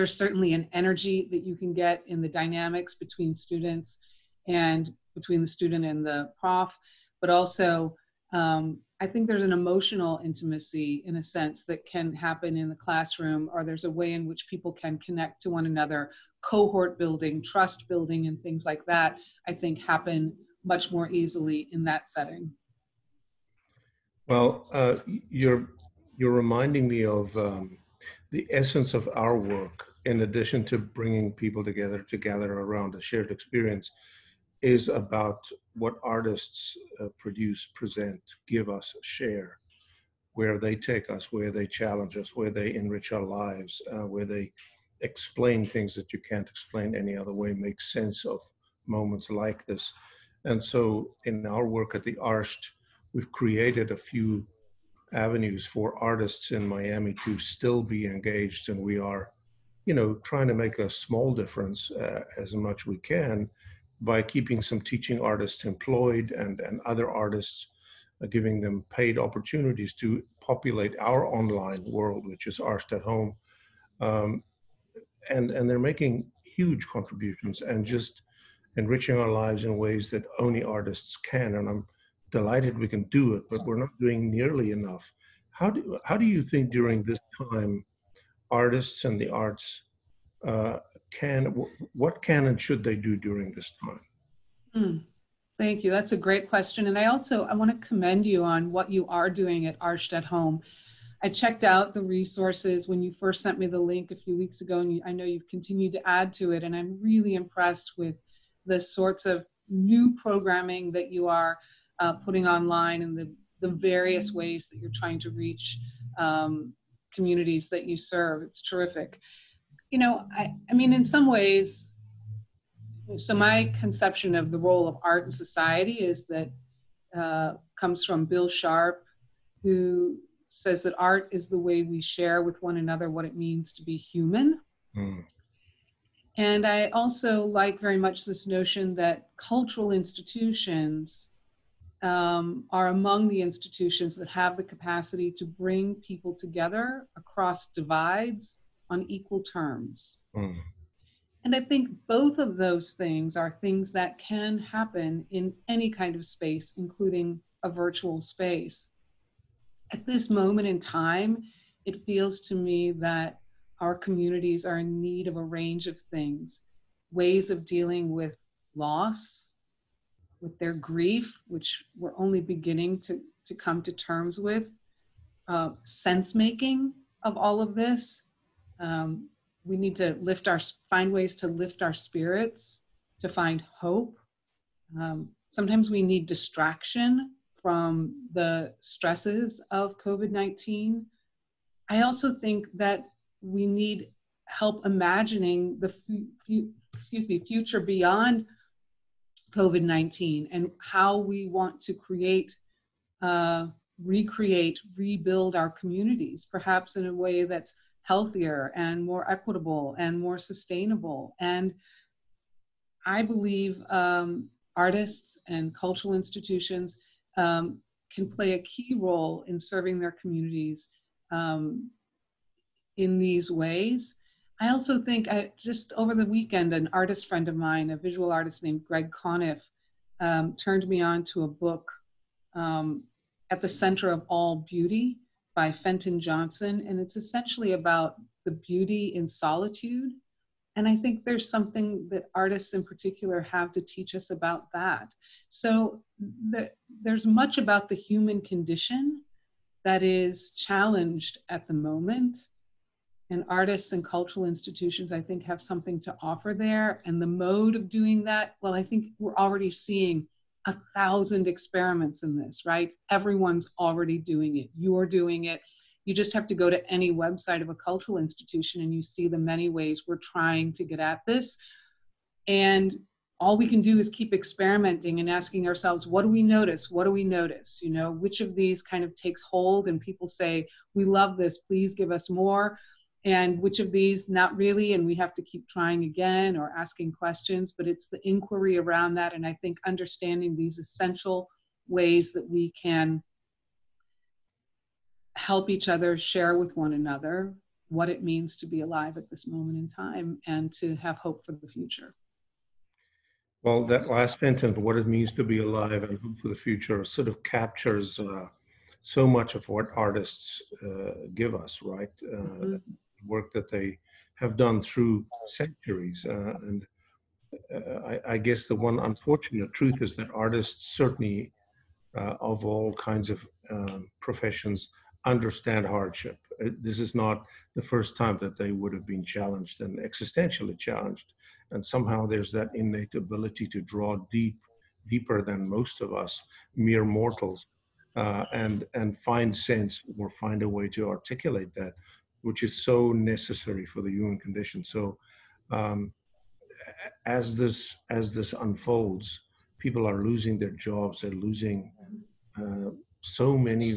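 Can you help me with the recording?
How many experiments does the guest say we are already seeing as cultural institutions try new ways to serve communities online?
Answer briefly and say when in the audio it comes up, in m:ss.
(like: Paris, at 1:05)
1,000, at 4:20.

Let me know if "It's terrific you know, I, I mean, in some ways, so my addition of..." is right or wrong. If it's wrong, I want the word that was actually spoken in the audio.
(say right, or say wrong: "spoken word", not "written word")
wrong: "conception", not "addition".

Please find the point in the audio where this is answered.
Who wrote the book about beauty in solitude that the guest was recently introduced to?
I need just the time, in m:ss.
3:55.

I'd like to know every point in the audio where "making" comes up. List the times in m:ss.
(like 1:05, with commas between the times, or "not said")
1:15, 2:56.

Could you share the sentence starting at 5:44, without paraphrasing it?
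So, um, as this as this unfolds, people are losing their jobs.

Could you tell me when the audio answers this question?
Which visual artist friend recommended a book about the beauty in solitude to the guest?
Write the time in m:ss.
3:48.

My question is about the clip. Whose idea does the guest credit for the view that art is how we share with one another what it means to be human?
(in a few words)
Bill Sharp.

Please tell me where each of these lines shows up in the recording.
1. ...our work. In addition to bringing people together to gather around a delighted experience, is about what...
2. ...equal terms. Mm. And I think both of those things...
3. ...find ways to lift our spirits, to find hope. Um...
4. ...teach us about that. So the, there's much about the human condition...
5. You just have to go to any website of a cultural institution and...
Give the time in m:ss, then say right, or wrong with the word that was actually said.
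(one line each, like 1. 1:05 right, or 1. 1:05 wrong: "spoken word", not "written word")
1. 0:29 wrong: "shared", not "delighted"
2. 2:29 right
3. 3:00 right
4. 4:03 right
5. 4:26 right.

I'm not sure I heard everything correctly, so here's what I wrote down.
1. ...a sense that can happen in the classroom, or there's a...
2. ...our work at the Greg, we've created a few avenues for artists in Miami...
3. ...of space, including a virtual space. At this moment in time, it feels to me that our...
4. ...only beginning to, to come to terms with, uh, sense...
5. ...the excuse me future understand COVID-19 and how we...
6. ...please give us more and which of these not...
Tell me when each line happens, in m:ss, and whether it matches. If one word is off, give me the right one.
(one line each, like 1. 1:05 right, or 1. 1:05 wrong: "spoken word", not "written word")
1. 0:11 right
2. 0:51 wrong: "Arsht", not "Greg"
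3. 2:36 right
4. 2:52 right
5. 3:15 wrong: "beyond", not "understand"
6. 4:41 right.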